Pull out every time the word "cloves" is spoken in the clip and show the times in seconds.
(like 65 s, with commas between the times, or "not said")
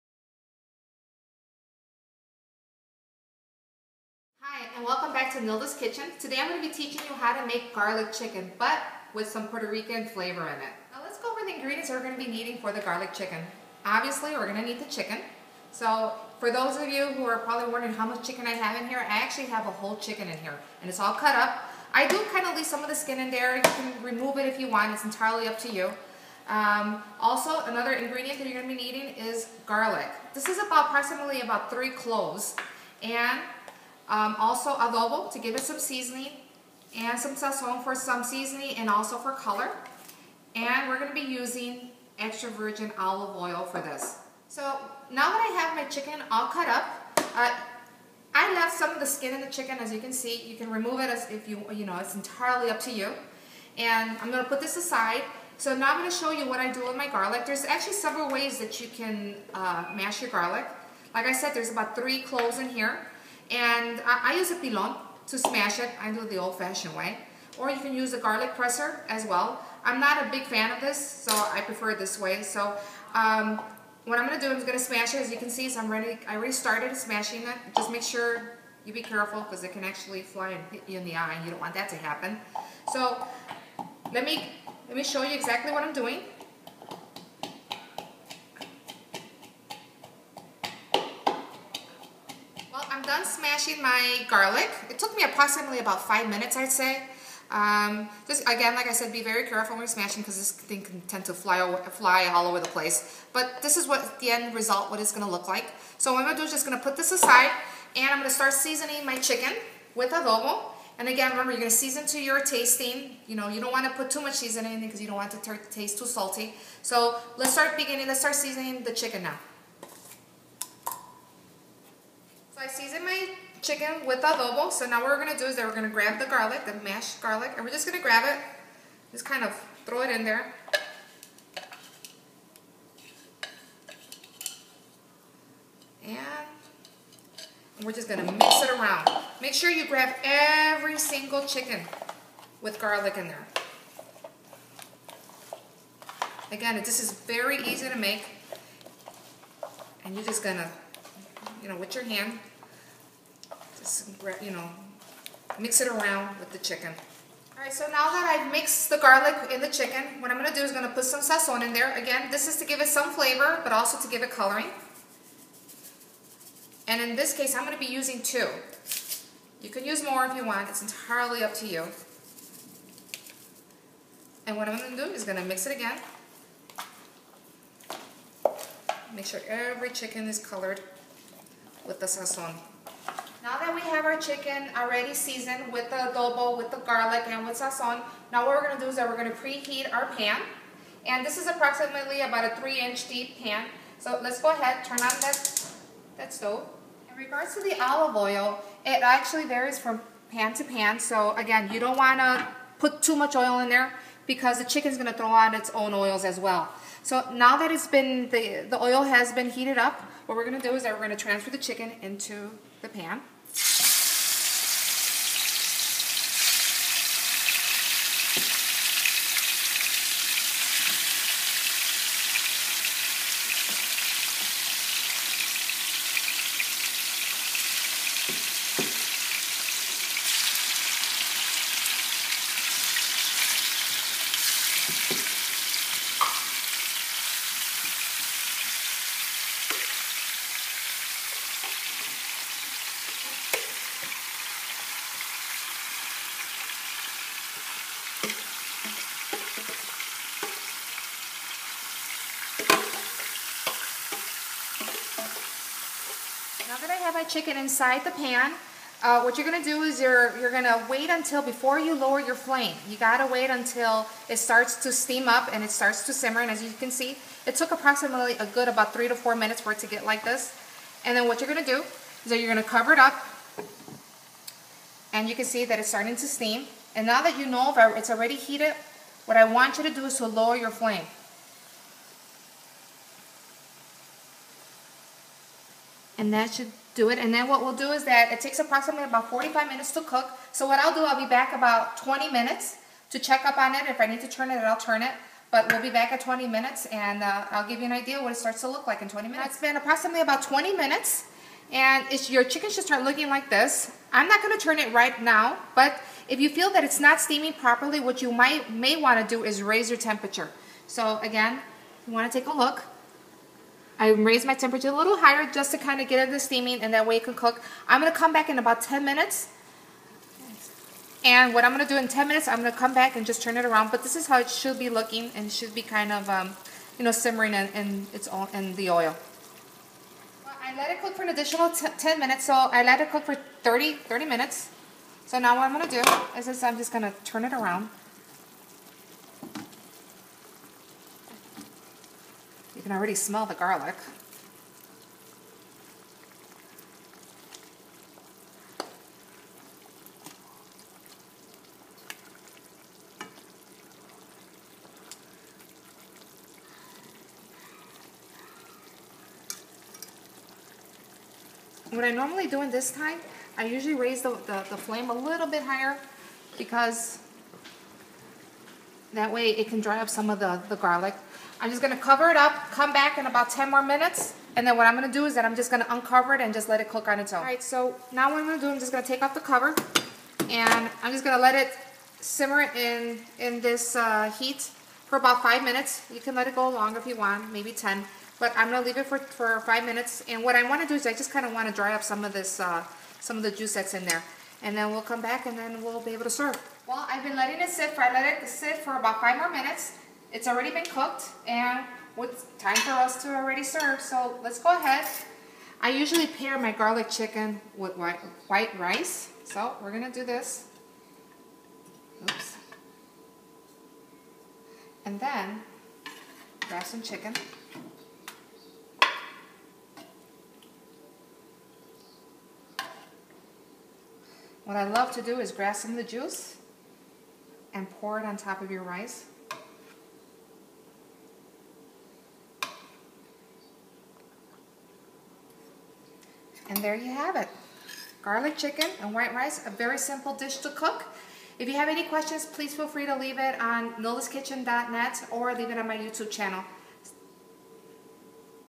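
31 s, 62 s.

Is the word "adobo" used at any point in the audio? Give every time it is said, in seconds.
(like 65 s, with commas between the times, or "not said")
34 s, 110 s, 124 s, 185 s.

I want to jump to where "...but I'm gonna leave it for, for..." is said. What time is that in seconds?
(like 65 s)
388 s.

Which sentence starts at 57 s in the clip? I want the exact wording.
There's actually several ways that you can uh, mash your garlic.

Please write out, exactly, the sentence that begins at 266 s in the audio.
And as you can see, it took approximately a good about three to four minutes for it to get like this.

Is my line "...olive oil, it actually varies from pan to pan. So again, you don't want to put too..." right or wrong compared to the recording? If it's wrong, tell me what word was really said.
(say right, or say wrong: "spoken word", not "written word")
right.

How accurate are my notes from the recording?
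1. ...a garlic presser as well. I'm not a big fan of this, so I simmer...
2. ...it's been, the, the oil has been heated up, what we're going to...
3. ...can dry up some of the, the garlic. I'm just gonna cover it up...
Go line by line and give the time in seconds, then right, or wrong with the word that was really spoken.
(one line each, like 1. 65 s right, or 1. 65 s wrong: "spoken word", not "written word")
1. 68 s wrong: "prefer", not "simmer"
2. 207 s right
3. 369 s right.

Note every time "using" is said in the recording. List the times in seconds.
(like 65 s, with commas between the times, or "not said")
41 s, 167 s.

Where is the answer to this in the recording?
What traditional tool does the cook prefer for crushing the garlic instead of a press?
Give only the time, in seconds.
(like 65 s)
64 s.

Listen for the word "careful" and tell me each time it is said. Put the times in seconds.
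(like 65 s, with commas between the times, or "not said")
79 s, 99 s.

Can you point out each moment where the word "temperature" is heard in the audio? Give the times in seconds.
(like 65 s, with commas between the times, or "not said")
309 s, 314 s.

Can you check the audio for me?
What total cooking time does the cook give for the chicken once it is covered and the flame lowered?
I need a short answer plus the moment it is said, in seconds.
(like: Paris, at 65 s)
45 minutes, at 289 s.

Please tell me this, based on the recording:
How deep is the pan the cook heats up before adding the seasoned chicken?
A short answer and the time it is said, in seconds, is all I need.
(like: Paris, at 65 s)
3 inches, at 192 s.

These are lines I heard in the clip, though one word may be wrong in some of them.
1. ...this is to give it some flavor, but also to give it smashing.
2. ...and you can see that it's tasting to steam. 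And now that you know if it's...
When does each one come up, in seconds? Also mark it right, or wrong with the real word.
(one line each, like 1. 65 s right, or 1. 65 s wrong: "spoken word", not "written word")
1. 162 s wrong: "coloring", not "smashing"
2. 275 s wrong: "starting", not "tasting".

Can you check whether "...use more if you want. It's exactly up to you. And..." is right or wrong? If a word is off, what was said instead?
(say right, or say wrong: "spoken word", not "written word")
wrong: "entirely", not "exactly".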